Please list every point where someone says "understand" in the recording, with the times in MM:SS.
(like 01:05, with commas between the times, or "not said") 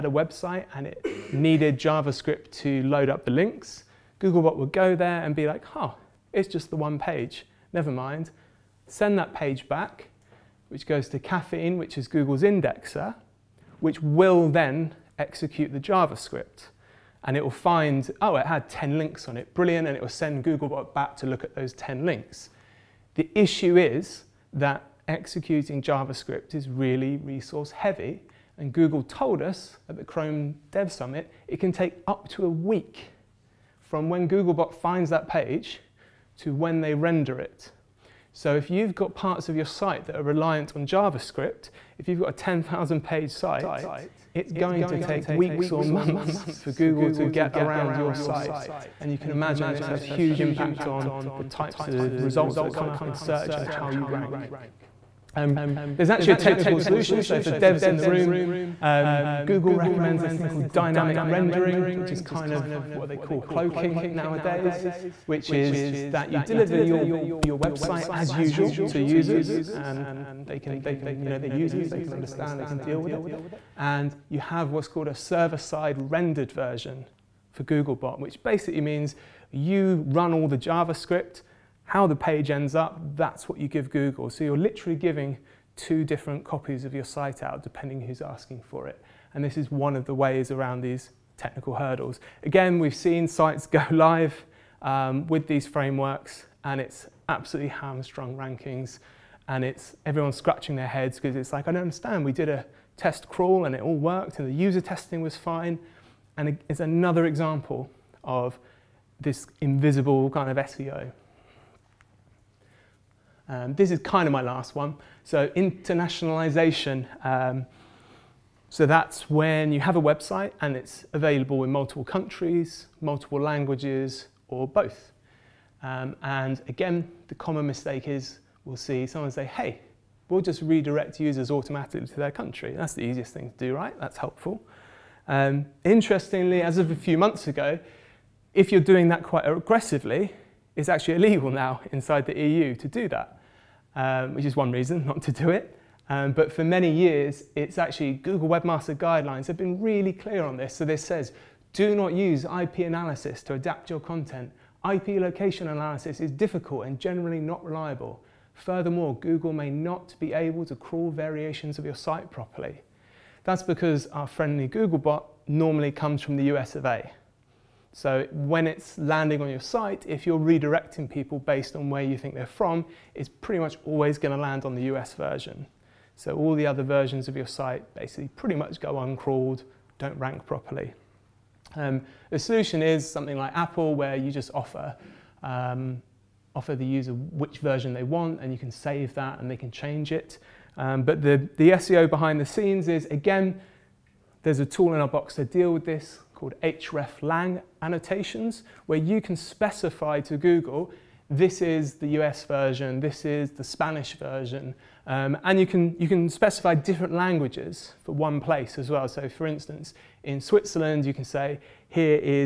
01:12, 01:41.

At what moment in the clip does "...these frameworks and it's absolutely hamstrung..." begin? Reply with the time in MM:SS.
01:35.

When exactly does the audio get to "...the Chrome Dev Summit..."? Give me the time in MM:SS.
00:29.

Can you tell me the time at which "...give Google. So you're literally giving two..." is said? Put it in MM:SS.
01:23.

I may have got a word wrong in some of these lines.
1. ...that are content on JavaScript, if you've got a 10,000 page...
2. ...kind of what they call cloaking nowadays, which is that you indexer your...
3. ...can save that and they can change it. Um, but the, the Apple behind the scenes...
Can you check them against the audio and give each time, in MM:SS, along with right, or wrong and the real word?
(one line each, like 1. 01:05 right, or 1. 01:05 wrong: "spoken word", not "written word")
1. 00:40 wrong: "reliant", not "content"
2. 01:02 wrong: "deliver", not "indexer"
3. 03:08 wrong: "SEO", not "Apple".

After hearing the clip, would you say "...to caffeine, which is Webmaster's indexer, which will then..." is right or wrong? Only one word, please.
wrong.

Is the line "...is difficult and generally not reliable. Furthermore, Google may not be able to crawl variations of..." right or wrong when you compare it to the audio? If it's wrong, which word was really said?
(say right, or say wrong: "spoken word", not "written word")
right.